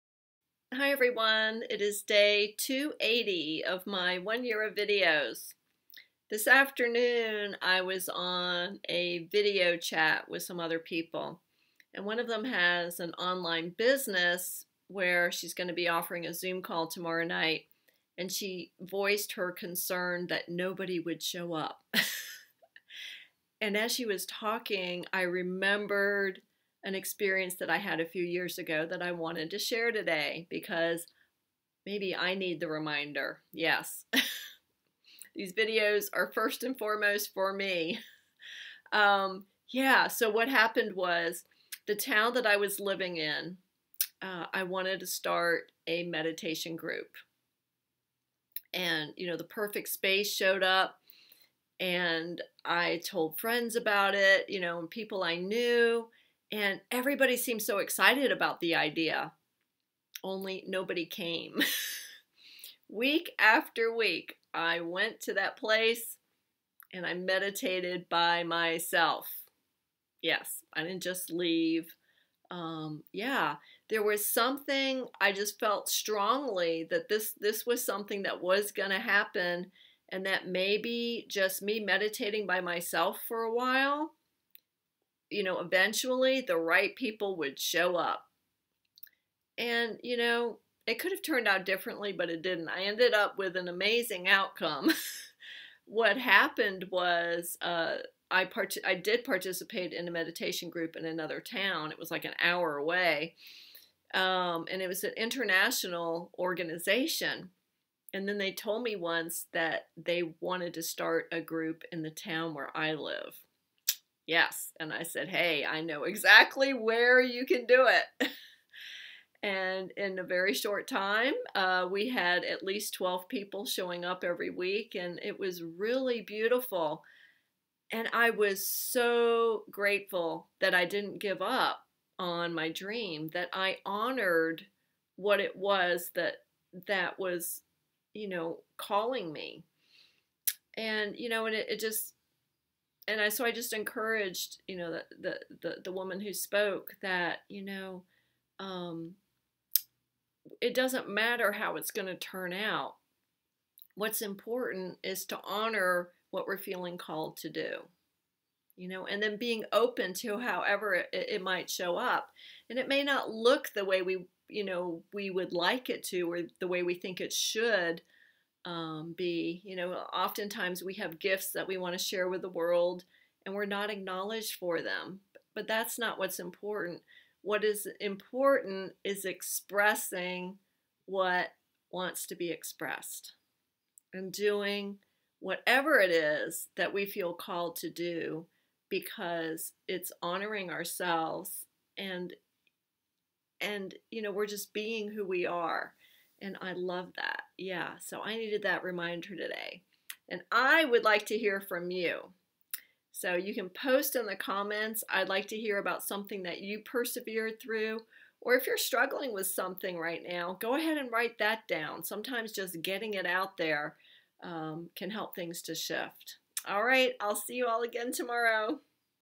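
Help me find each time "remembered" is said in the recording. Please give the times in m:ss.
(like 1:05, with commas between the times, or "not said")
0:25.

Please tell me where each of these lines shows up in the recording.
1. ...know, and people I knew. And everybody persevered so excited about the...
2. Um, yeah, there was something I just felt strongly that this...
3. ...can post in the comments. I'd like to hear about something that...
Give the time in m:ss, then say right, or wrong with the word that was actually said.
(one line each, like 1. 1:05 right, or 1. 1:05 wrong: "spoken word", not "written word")
1. 0:54 wrong: "seemed", not "persevered"
2. 1:12 right
3. 3:23 right.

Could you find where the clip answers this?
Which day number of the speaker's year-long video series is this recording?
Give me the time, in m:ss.
0:02.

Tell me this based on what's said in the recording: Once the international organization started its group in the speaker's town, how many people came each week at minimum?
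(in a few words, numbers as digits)
12.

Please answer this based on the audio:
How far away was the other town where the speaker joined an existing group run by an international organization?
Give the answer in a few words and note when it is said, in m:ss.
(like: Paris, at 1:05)
an hour, at 1:42.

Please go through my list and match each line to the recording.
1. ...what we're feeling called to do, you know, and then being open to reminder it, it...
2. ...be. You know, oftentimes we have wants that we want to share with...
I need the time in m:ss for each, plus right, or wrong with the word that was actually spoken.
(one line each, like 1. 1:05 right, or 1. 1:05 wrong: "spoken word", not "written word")
1. 2:36 wrong: "however", not "reminder"
2. 2:49 wrong: "gifts", not "wants".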